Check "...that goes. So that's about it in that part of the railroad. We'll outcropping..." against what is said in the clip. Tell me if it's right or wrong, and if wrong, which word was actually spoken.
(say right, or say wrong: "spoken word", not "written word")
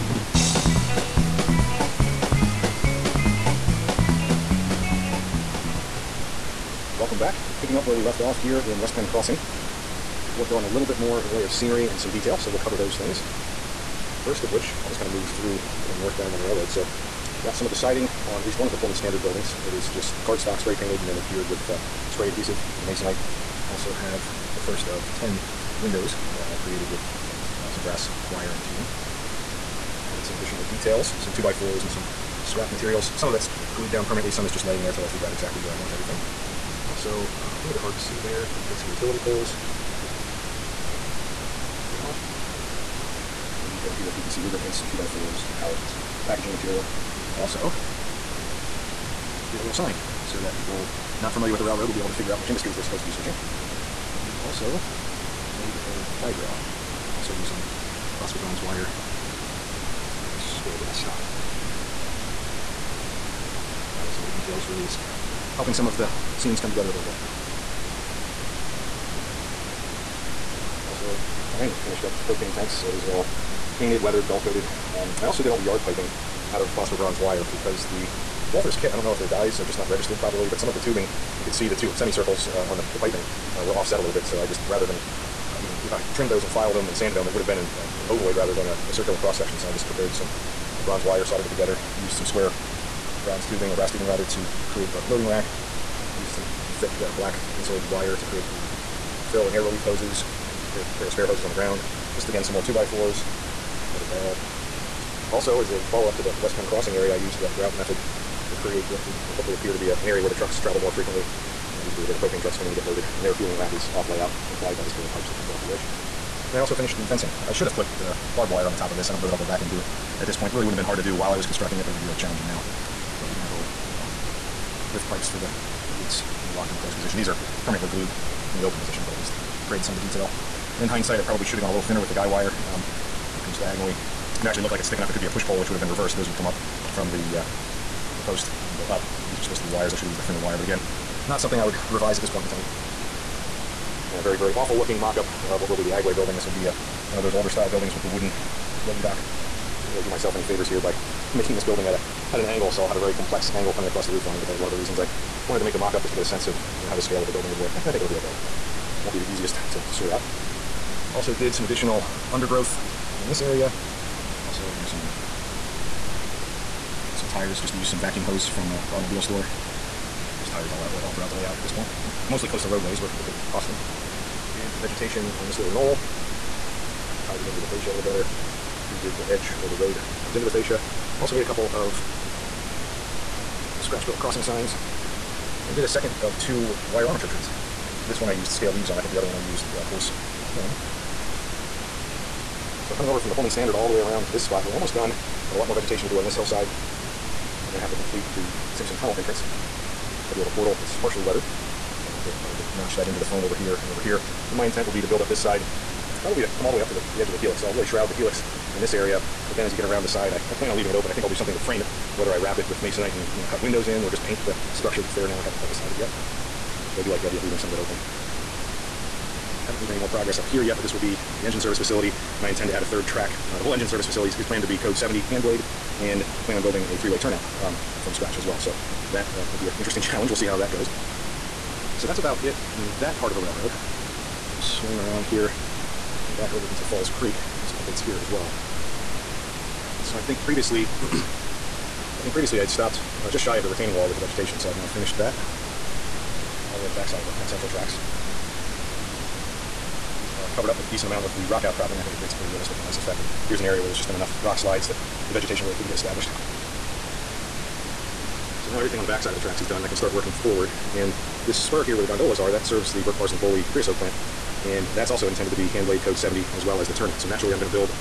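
wrong: "swing", not "outcropping".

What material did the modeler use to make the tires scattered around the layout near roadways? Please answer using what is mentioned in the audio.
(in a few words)
vacuum hose.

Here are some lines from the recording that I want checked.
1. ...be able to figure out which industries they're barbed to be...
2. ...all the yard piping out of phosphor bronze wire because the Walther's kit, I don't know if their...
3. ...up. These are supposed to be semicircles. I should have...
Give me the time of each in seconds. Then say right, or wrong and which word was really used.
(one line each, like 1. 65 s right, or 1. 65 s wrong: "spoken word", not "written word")
1. 51 s wrong: "supposed", not "barbed"
2. 75 s right
3. 138 s wrong: "wires", not "semicircles".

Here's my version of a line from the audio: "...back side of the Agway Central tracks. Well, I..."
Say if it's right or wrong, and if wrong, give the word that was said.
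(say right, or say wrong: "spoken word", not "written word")
wrong: "Penn", not "Agway".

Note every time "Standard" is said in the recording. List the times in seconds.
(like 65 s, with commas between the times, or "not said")
18 s, 193 s.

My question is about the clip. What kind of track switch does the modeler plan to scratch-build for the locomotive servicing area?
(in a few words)
three-way turnout.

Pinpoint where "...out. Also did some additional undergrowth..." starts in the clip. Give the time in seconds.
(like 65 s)
160 s.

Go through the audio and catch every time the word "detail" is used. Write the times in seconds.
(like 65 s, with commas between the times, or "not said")
12 s, 30 s, 43 s, 64 s, 129 s.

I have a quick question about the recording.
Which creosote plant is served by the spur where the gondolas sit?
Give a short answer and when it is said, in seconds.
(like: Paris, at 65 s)
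Burke Parsons Bowlby, at 263 s.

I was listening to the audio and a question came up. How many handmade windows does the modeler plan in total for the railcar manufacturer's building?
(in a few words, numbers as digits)
10.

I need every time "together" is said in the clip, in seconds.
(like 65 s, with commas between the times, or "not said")
66 s, 91 s.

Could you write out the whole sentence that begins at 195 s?
Have a lot more vegetation to do on this hillside.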